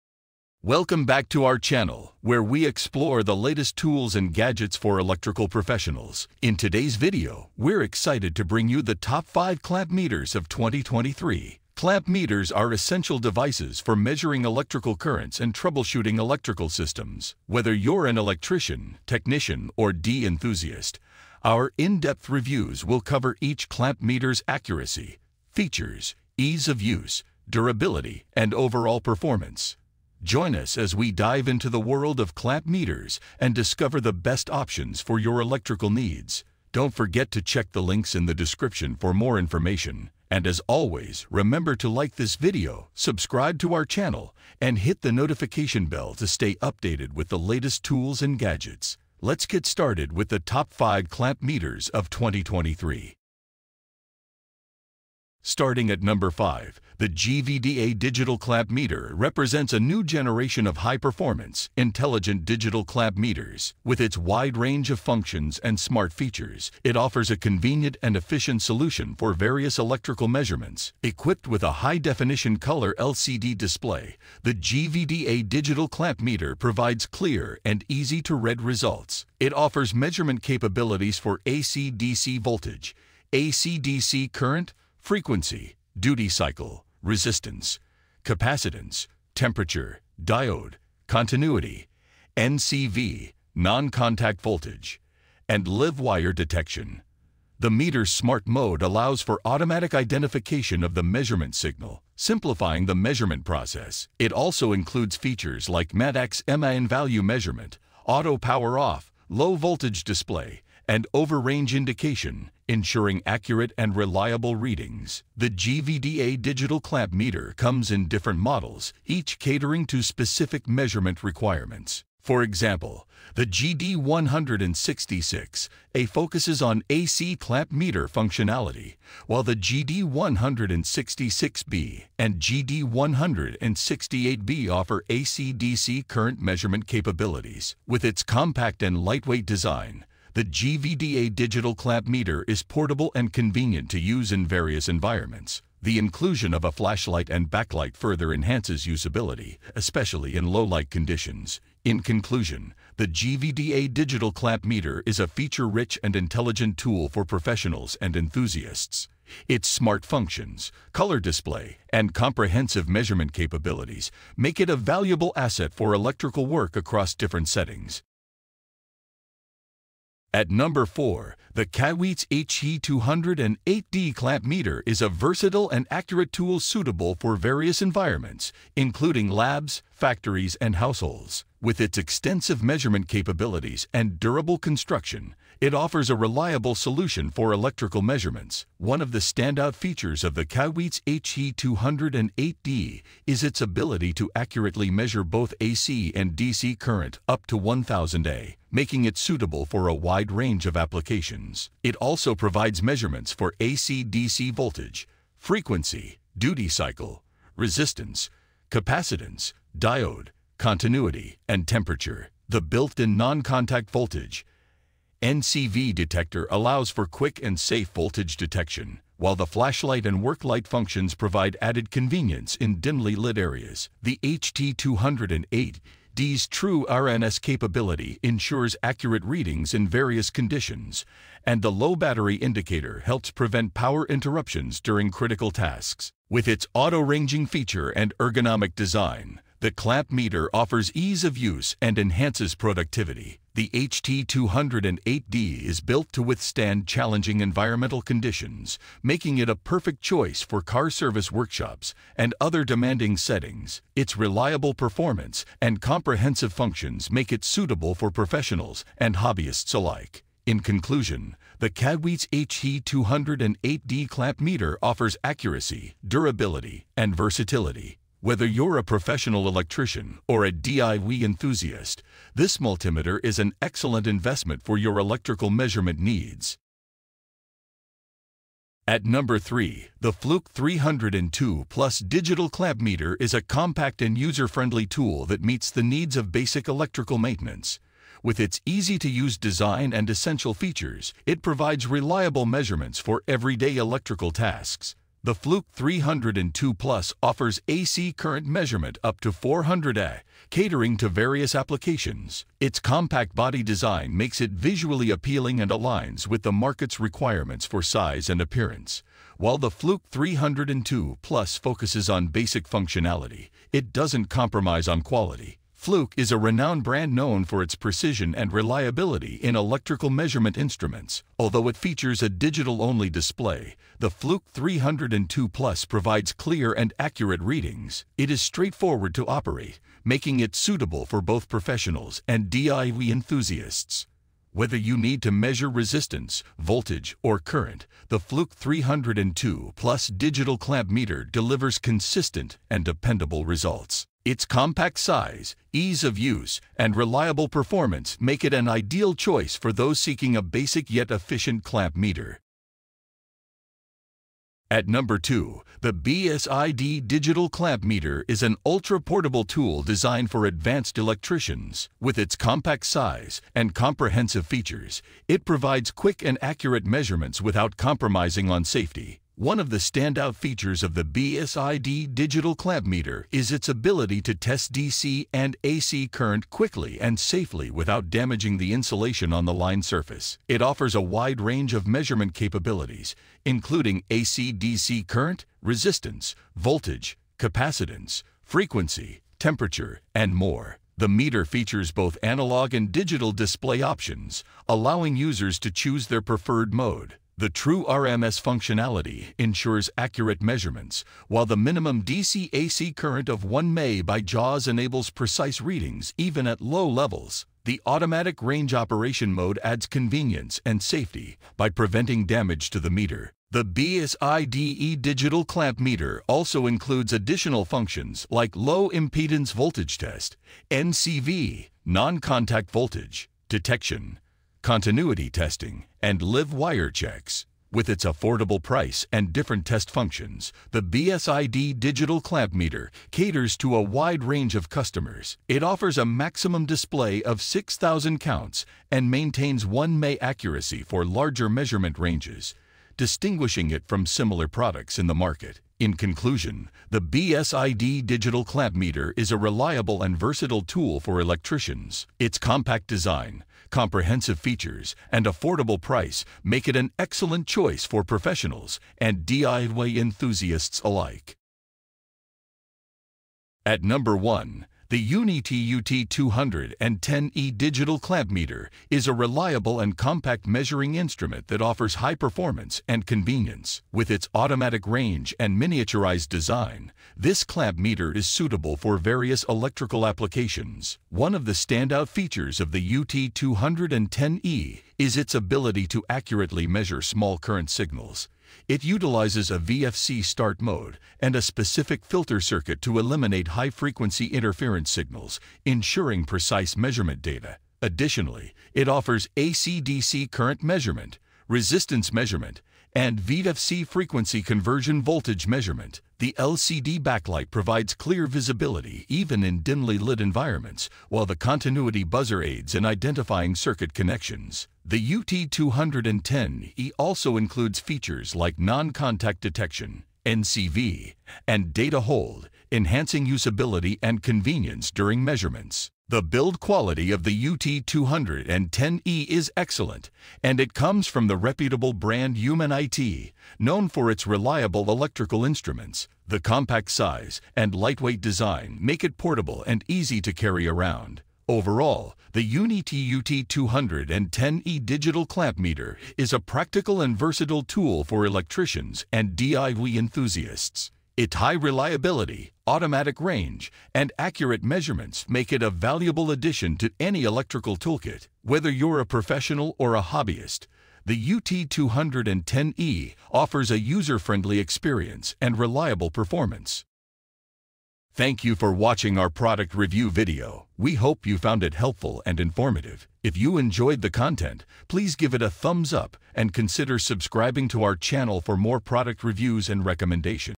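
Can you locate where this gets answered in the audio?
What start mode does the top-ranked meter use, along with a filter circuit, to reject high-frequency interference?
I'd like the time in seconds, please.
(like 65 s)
489 s.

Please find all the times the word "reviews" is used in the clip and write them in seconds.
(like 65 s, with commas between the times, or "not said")
22 s, 569 s, 579 s.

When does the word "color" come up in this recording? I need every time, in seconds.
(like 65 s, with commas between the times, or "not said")
72 s, 160 s.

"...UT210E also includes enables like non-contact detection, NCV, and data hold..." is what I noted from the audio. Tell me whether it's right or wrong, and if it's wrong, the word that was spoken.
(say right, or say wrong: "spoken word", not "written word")
wrong: "features", not "enables".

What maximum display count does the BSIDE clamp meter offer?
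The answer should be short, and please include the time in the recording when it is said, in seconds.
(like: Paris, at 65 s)
6,000 counts, at 437 s.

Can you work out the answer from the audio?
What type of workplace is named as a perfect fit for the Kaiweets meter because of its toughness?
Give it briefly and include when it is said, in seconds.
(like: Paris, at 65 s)
car service workshops, at 250 s.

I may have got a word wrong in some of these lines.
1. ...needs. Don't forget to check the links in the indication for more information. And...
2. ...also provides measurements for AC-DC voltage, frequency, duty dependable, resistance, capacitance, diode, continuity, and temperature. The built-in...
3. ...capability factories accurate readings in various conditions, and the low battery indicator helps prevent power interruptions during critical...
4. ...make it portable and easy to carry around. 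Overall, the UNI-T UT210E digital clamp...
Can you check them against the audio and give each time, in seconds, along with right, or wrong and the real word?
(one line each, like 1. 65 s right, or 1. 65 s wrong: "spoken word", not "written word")
1. 35 s wrong: "description", not "indication"
2. 201 s wrong: "cycle", not "dependable"
3. 227 s wrong: "ensures", not "factories"
4. 538 s right.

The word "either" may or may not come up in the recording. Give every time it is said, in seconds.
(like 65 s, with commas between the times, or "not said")
not said.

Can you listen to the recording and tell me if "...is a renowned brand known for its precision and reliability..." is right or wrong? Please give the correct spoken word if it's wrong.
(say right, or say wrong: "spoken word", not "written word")
right.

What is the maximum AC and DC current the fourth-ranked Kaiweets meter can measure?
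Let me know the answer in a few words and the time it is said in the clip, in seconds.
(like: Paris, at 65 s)
1000 A, at 197 s.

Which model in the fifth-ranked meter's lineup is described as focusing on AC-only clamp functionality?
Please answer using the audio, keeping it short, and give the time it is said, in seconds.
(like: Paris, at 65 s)
GD166A, at 123 s.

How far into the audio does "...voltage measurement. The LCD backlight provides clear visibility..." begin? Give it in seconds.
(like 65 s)
505 s.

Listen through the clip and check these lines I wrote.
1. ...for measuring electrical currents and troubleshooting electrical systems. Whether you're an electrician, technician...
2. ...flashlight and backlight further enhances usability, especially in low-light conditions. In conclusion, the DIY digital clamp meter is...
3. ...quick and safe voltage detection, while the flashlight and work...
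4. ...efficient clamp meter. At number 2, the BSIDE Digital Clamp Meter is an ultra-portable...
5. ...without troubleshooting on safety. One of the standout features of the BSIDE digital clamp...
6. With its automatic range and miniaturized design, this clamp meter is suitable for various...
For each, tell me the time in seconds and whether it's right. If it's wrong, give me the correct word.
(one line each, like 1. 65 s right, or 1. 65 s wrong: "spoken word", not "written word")
1. 13 s right
2. 146 s wrong: "GVDA", not "DIY"
3. 217 s right
4. 351 s right
5. 367 s wrong: "compromising", not "troubleshooting"
6. 473 s right.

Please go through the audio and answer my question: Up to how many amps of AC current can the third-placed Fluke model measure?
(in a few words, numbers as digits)
400 A.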